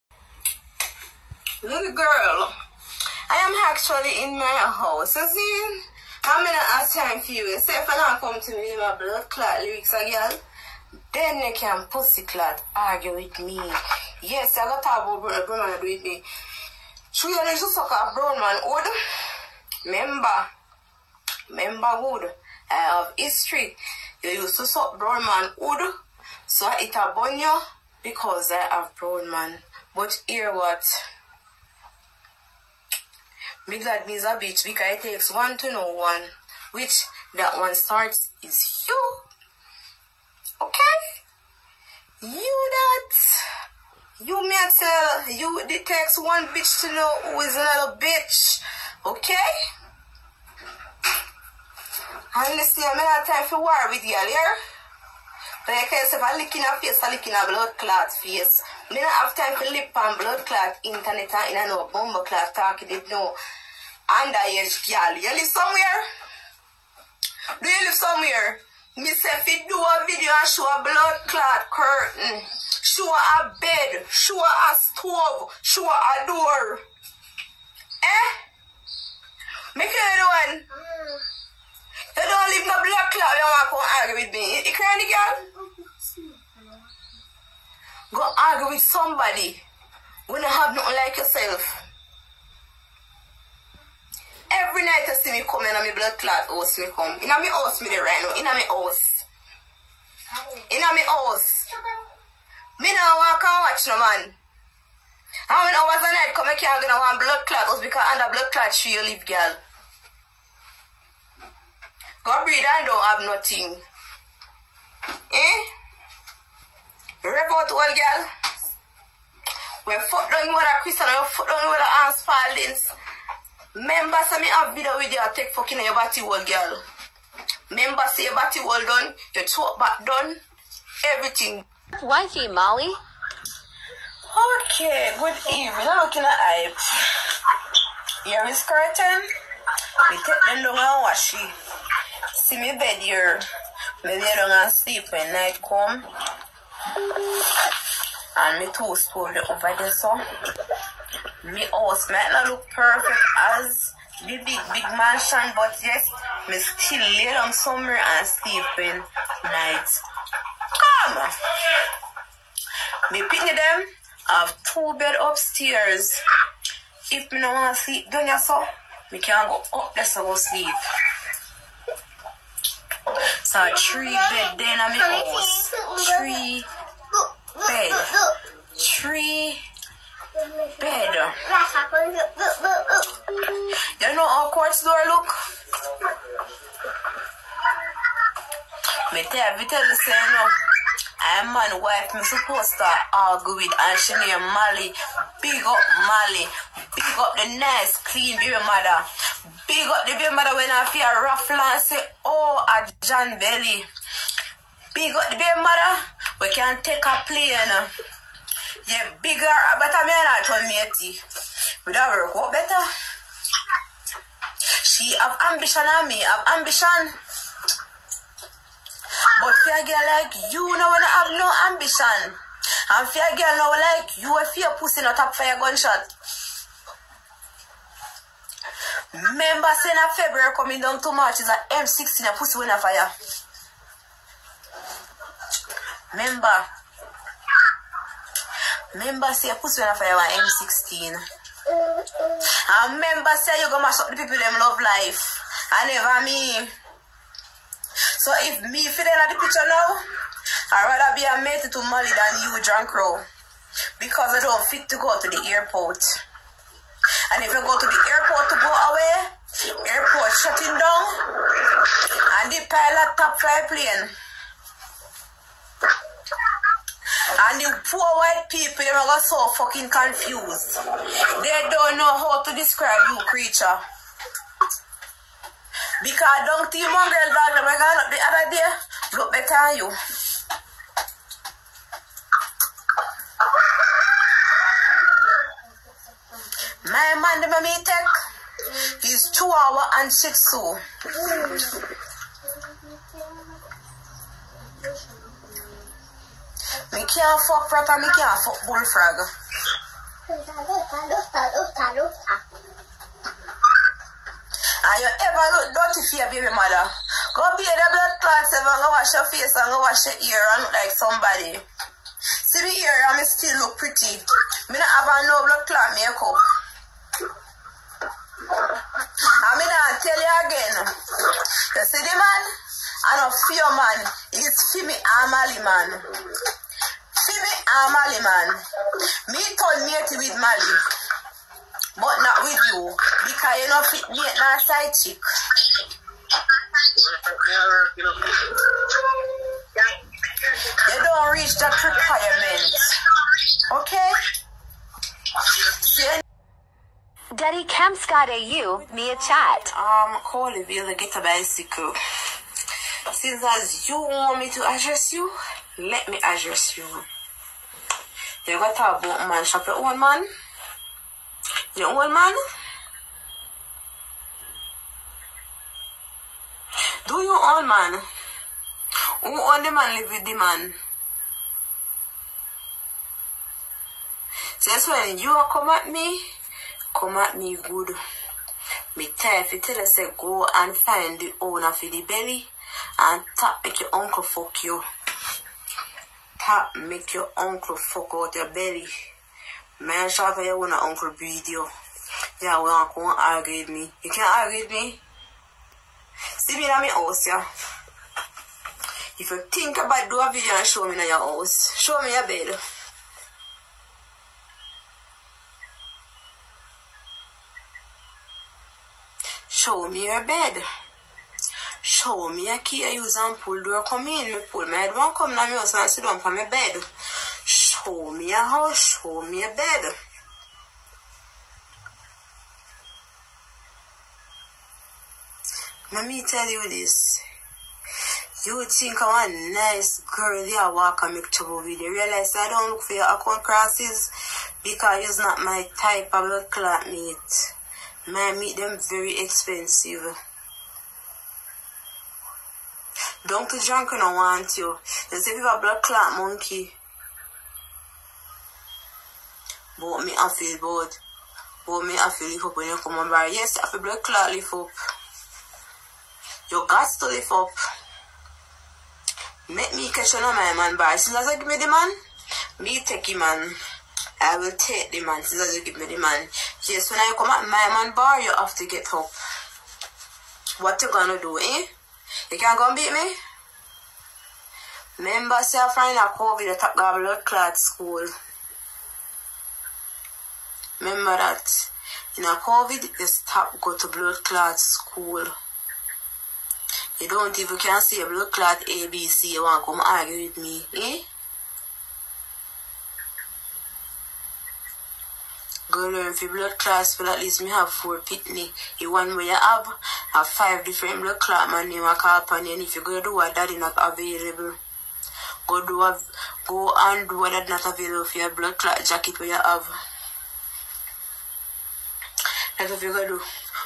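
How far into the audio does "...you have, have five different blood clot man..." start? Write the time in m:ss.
8:19.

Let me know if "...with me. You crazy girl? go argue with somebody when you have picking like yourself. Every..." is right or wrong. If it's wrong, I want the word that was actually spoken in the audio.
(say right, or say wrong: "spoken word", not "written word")
wrong: "nothing", not "picking".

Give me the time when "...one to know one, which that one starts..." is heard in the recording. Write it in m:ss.
0:35.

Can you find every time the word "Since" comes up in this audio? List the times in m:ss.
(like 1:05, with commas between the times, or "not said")
5:53, 6:14.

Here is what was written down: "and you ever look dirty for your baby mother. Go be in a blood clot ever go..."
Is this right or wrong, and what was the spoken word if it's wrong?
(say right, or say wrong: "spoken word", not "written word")
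right.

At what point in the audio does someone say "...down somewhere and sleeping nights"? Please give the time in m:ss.
2:37.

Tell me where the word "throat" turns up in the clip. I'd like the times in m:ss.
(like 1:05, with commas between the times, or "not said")
2:09.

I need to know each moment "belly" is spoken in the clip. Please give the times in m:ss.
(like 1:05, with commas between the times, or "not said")
3:23, 6:22, 6:28.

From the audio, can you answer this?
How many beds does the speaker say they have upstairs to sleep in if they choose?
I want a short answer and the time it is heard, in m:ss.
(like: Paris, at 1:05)
2, at 2:44.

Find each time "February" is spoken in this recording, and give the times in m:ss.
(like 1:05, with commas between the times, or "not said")
3:50.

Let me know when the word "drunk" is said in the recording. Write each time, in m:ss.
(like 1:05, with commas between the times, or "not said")
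4:12, 7:23.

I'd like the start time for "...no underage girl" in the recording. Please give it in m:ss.
1:03.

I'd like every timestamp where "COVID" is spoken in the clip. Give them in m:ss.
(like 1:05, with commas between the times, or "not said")
7:56, 8:02.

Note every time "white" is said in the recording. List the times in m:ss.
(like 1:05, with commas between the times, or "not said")
4:28.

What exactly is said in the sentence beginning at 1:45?
How many hours a night come here can I want blood clot house because under blood clot she you live girl.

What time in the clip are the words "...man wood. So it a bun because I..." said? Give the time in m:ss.
0:25.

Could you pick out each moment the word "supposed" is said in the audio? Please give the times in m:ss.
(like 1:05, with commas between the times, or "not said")
3:12.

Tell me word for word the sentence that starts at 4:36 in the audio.
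Because don't think one girl dog that I got up the other day look better than you.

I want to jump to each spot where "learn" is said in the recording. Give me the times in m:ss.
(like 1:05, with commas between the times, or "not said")
8:15.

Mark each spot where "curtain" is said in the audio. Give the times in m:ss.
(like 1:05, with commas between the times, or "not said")
1:11, 2:18.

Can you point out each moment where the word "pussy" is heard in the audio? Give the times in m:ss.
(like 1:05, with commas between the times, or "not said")
0:11, 3:44, 3:52, 3:59.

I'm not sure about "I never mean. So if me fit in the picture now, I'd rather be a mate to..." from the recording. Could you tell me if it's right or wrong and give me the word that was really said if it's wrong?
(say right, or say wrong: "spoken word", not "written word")
right.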